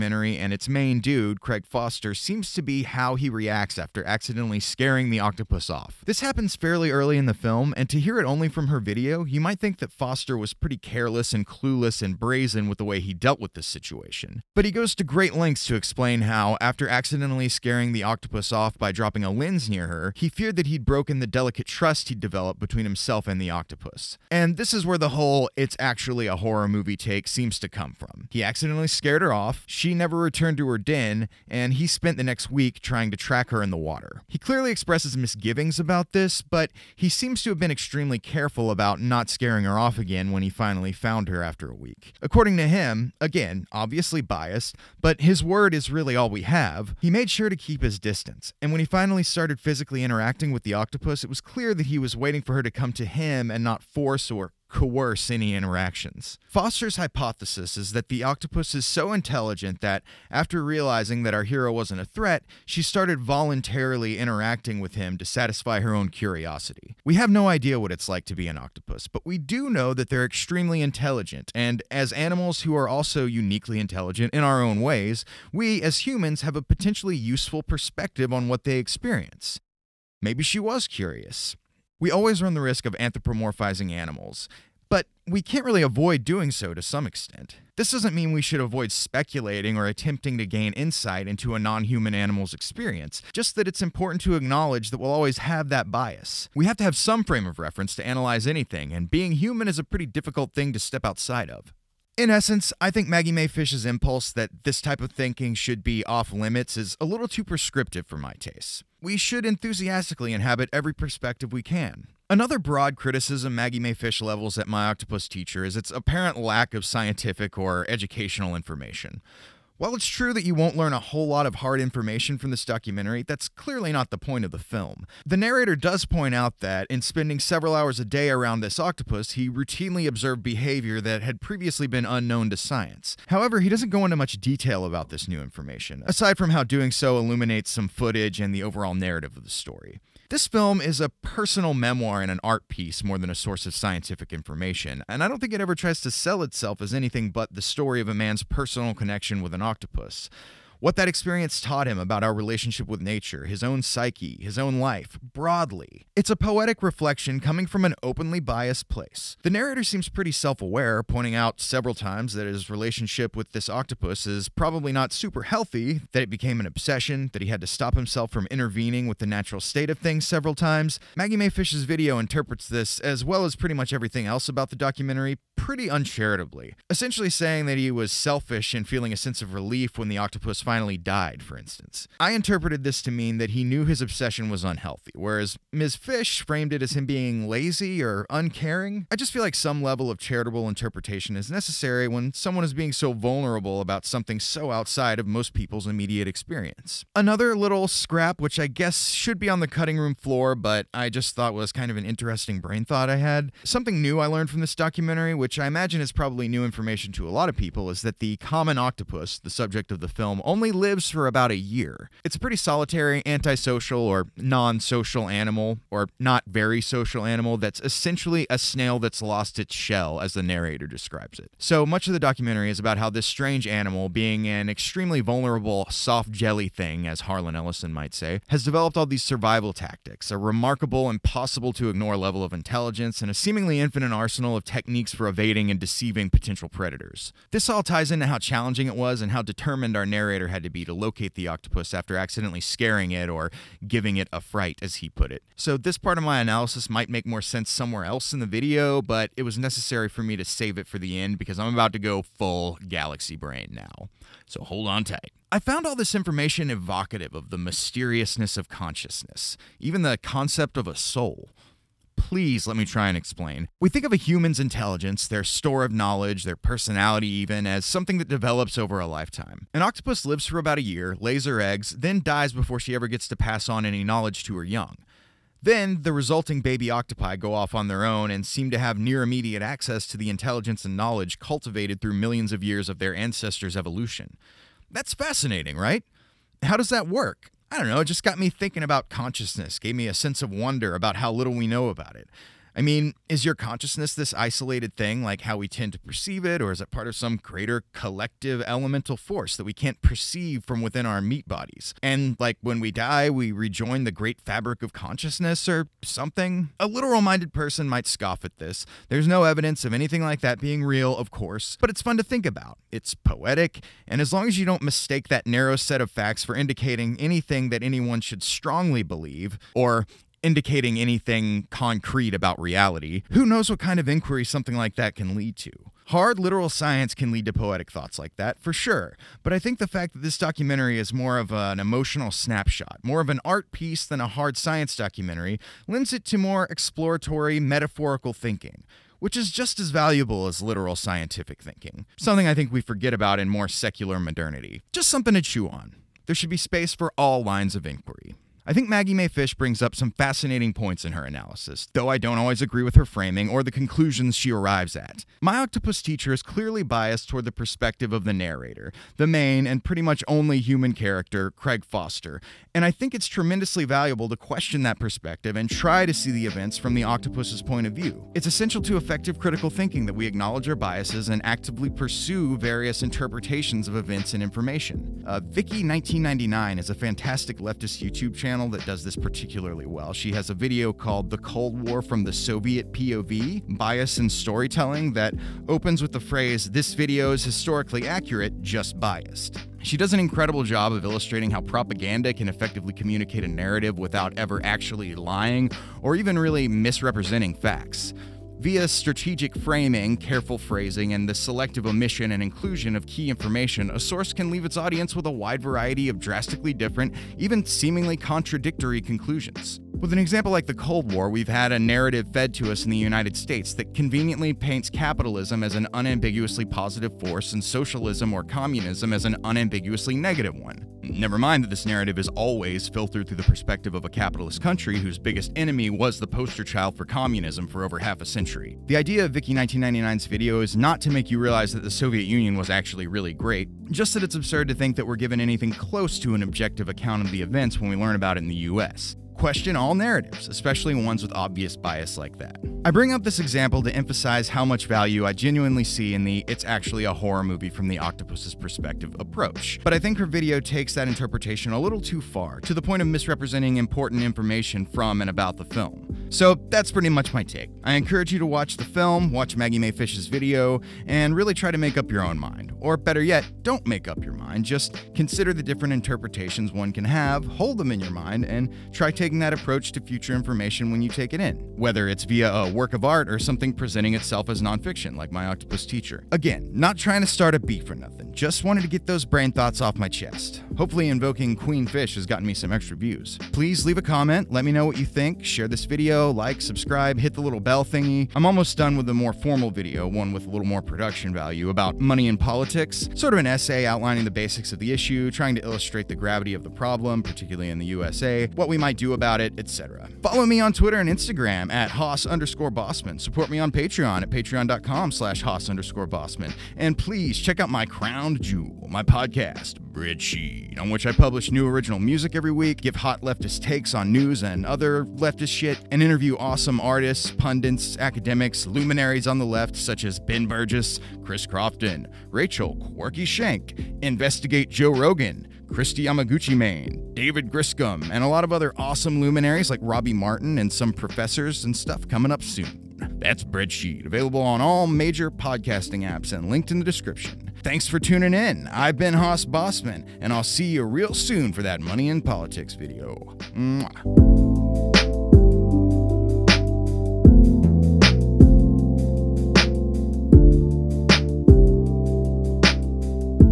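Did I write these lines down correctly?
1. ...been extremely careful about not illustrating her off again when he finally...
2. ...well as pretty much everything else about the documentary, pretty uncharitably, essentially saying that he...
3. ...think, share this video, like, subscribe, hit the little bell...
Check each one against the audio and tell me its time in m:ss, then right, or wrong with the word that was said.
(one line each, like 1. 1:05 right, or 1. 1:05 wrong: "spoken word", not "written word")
1. 0:37 wrong: "scaring", not "illustrating"
2. 2:53 right
3. 8:05 right.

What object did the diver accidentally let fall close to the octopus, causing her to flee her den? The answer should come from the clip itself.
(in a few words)
A lens.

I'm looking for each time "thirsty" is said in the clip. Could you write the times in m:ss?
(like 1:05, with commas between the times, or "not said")
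not said.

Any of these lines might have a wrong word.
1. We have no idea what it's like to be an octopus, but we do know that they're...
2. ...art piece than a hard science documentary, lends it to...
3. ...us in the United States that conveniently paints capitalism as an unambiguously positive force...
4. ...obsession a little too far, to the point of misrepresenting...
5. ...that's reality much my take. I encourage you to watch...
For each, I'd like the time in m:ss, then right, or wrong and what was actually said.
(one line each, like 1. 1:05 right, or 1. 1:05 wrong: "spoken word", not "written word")
1. 1:07 right
2. 5:33 right
3. 6:52 right
4. 7:31 wrong: "interpretation", not "obsession"
5. 7:36 wrong: "pretty", not "reality".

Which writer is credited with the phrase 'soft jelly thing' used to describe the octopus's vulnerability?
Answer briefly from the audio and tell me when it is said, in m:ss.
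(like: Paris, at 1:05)
Harlan Ellison, at 3:47.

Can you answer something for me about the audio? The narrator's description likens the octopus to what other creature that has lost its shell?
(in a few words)
A snail.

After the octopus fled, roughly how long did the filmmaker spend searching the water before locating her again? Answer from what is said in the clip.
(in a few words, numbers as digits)
A week.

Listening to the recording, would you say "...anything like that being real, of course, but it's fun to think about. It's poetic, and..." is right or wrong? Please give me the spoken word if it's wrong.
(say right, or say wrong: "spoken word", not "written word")
right.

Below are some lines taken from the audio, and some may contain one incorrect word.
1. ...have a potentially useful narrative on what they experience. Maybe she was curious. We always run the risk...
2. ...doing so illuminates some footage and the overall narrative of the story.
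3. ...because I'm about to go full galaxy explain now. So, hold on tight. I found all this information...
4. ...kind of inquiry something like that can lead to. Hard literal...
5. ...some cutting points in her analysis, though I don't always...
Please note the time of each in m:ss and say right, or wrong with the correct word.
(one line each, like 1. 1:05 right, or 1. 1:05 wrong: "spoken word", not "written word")
1. 1:16 wrong: "perspective", not "narrative"
2. 2:16 right
3. 4:11 wrong: "brain", not "explain"
4. 5:23 right
5. 5:49 wrong: "fascinating", not "cutting".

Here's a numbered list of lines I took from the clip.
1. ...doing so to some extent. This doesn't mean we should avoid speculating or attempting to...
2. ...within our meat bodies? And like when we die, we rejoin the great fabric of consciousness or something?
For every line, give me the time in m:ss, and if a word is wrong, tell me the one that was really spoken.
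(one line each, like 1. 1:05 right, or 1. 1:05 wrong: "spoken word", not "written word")
1. 1:26 right
2. 5:00 right.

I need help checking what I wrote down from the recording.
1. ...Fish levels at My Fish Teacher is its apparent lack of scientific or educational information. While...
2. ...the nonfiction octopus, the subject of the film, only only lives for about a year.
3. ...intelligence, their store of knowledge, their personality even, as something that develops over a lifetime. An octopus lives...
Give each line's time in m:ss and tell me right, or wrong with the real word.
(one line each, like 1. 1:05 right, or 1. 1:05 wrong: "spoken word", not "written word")
1. 1:53 wrong: "Octopus", not "Fish"
2. 3:28 wrong: "common", not "nonfiction"
3. 4:24 right.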